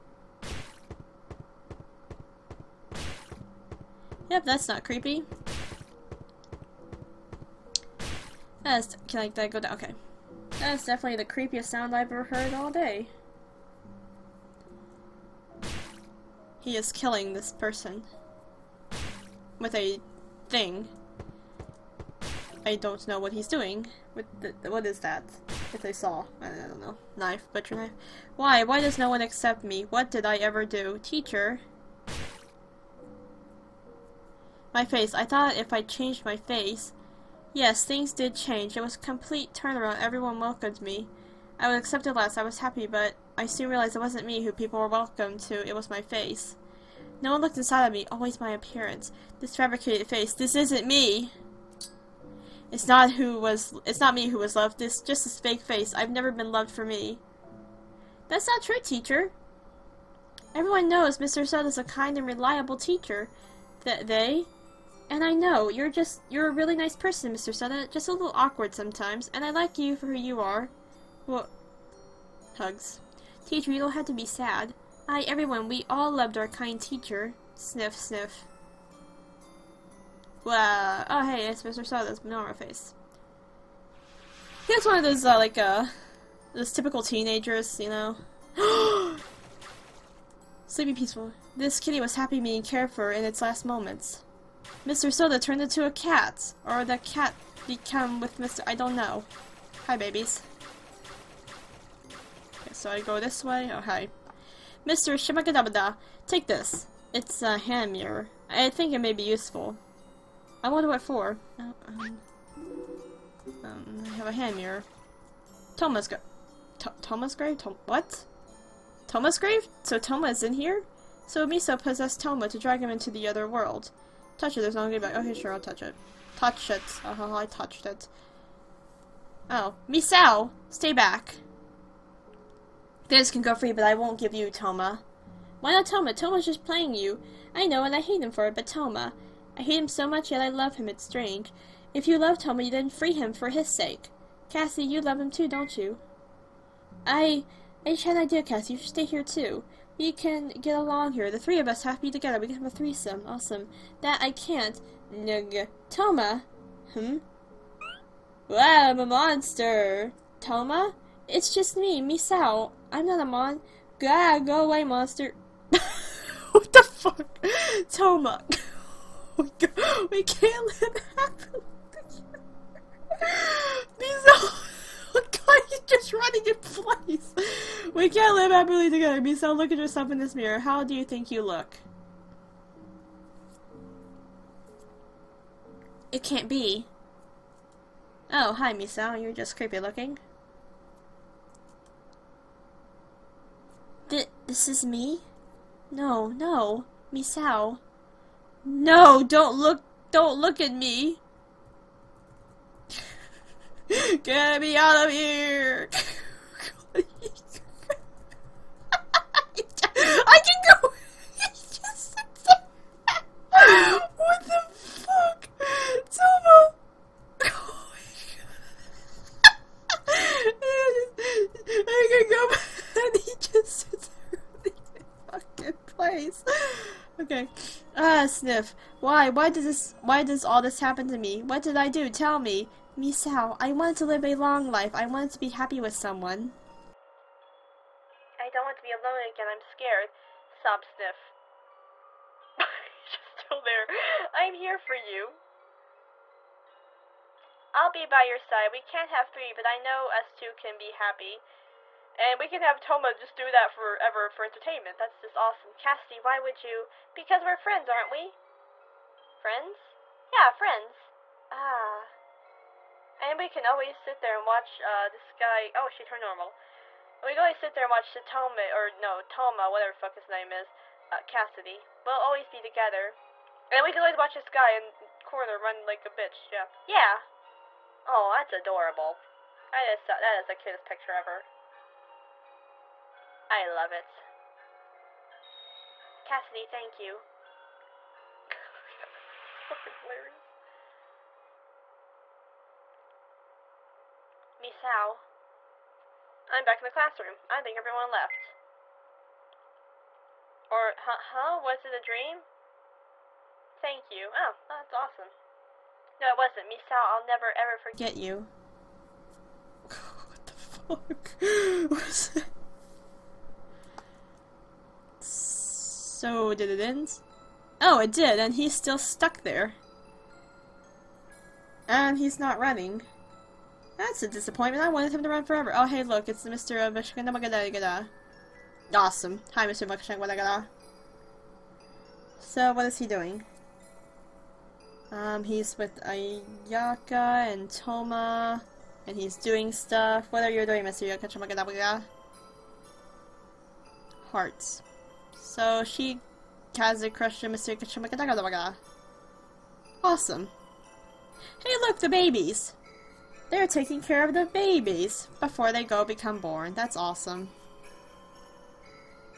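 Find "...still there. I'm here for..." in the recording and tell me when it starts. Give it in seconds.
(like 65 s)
243 s.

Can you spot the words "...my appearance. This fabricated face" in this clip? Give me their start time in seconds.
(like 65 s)
48 s.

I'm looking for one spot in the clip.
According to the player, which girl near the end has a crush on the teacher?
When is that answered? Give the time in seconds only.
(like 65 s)
336 s.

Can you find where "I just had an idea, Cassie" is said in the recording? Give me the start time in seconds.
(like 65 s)
147 s.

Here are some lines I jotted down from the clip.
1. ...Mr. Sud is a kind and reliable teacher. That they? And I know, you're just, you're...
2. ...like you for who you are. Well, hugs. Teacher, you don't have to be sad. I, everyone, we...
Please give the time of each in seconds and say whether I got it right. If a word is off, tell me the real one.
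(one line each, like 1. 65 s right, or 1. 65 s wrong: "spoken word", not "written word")
1. 61 s right
2. 69 s right.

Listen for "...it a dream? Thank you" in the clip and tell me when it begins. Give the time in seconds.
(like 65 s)
301 s.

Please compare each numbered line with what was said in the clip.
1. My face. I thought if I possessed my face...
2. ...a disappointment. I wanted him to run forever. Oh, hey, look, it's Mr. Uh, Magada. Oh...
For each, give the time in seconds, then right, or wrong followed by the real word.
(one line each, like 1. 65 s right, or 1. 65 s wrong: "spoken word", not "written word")
1. 34 s wrong: "changed", not "possessed"
2. 324 s right.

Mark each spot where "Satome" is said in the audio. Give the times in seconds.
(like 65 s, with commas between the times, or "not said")
268 s.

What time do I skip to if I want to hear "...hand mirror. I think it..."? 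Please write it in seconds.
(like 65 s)
107 s.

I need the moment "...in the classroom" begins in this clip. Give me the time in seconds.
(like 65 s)
296 s.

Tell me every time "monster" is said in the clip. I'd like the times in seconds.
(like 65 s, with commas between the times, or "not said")
159 s, 164 s.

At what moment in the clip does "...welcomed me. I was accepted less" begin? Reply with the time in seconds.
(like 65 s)
40 s.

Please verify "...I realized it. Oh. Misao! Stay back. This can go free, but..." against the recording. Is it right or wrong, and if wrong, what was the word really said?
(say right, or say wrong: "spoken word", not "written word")
wrong: "touched", not "realized".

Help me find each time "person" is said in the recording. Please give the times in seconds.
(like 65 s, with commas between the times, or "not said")
17 s, 66 s.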